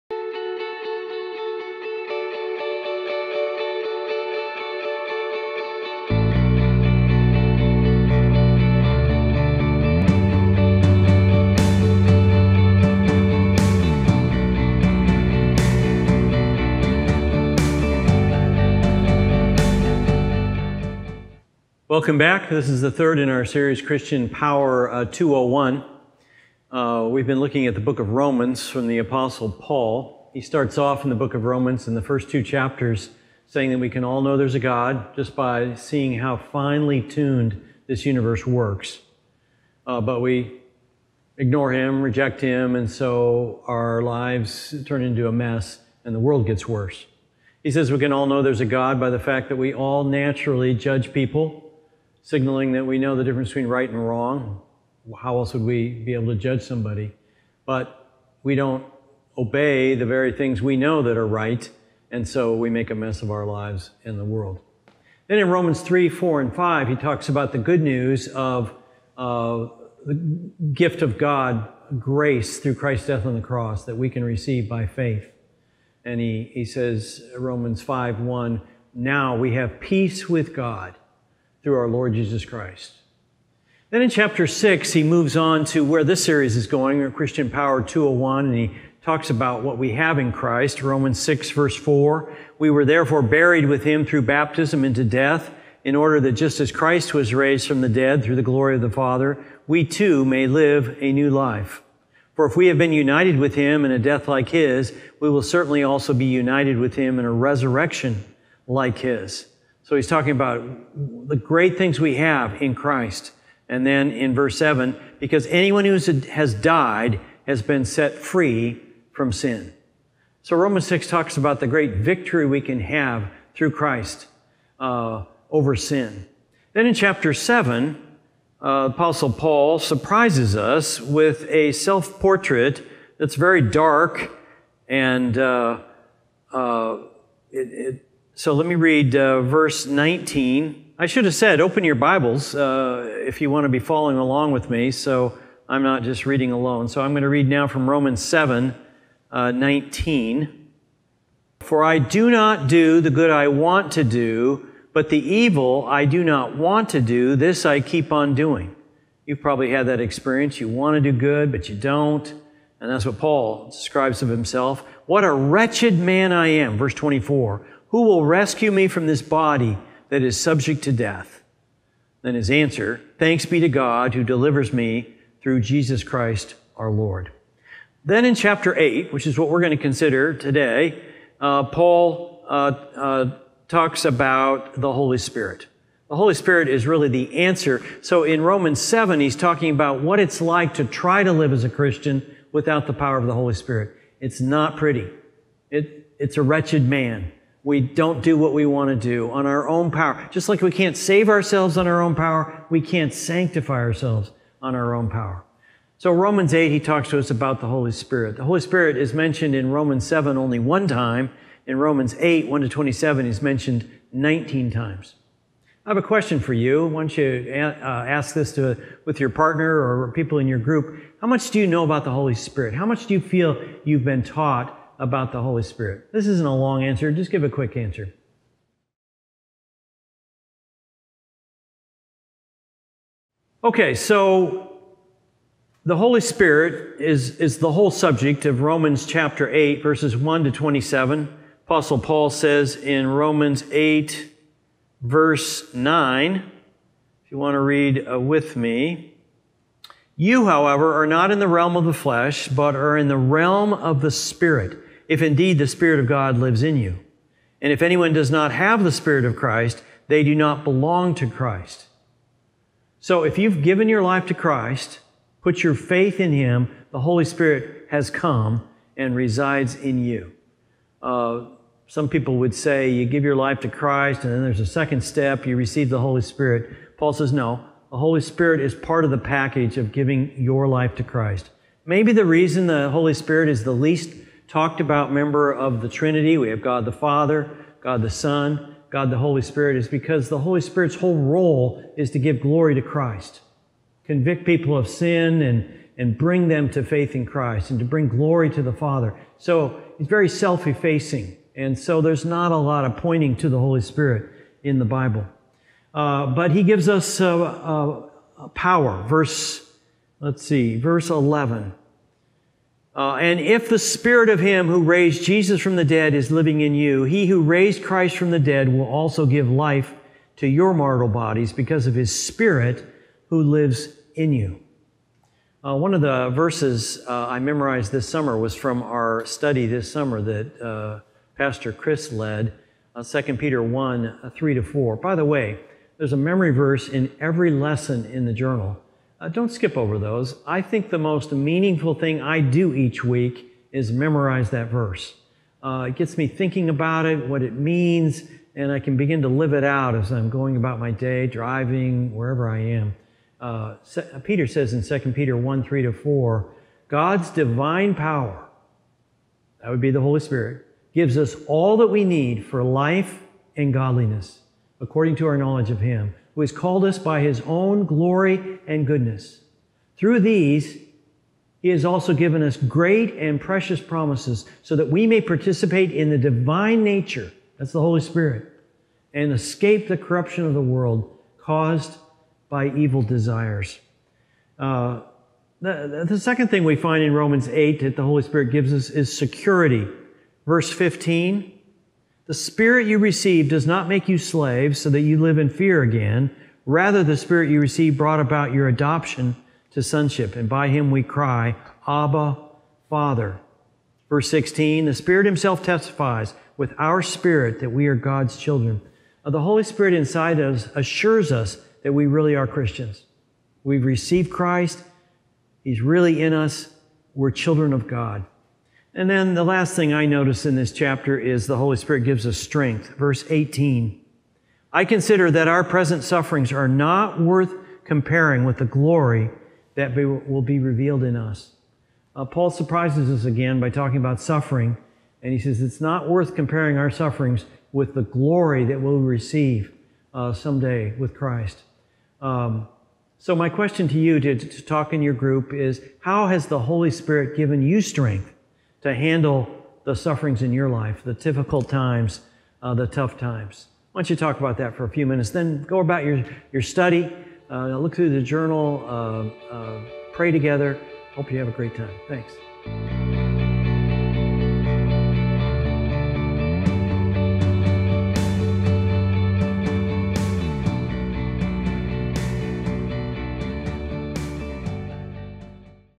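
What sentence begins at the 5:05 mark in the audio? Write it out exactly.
Uh, but he gives us uh, uh, power.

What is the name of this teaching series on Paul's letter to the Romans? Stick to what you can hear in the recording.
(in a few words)
Christian Power 201.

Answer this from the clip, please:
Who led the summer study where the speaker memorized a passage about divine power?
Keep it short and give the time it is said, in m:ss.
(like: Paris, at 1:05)
Pastor Chris, at 5:31.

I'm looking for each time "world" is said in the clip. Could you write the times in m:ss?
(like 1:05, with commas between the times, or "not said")
0:46, 1:04, 6:20.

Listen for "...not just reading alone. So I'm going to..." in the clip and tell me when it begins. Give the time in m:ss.
2:25.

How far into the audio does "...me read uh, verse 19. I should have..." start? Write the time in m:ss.
2:18.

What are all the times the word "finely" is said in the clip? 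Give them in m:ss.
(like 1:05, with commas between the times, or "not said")
0:36.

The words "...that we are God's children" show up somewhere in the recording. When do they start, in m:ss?
6:47.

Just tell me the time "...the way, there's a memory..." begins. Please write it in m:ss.
5:35.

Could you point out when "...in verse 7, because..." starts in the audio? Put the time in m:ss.
1:54.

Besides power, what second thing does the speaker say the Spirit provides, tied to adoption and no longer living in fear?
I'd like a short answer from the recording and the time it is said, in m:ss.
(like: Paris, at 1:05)
Security, at 6:29.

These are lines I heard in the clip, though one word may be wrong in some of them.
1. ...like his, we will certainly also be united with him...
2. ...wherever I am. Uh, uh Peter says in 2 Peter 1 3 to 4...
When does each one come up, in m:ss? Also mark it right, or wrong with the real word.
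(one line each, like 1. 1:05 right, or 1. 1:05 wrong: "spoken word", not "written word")
1. 1:44 right
2. 5:52 right.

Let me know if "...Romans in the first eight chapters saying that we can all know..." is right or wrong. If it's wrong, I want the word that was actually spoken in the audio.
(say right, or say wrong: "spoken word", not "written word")
wrong: "two", not "eight".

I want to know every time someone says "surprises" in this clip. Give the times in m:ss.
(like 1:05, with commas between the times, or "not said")
2:09, 7:12.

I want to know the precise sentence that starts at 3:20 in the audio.
Just like we can't save ourselves on our own power, we can't sanctify ourselves on our own power.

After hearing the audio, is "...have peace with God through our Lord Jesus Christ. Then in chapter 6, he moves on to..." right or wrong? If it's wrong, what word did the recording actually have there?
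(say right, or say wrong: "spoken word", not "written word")
right.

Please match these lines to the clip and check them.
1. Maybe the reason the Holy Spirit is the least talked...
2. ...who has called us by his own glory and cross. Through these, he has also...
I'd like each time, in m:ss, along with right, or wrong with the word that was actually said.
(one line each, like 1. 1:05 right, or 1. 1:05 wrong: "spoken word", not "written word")
1. 4:41 right
2. 6:06 wrong: "goodness", not "cross".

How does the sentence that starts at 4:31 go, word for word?
Uh, some people would say you give your life to Christ, and then there's a second step, you receive the Holy Spirit.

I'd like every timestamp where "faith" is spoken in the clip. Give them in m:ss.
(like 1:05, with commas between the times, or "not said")
1:14, 4:25, 4:56.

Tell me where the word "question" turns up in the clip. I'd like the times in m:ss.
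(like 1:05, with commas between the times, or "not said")
3:36, 7:23.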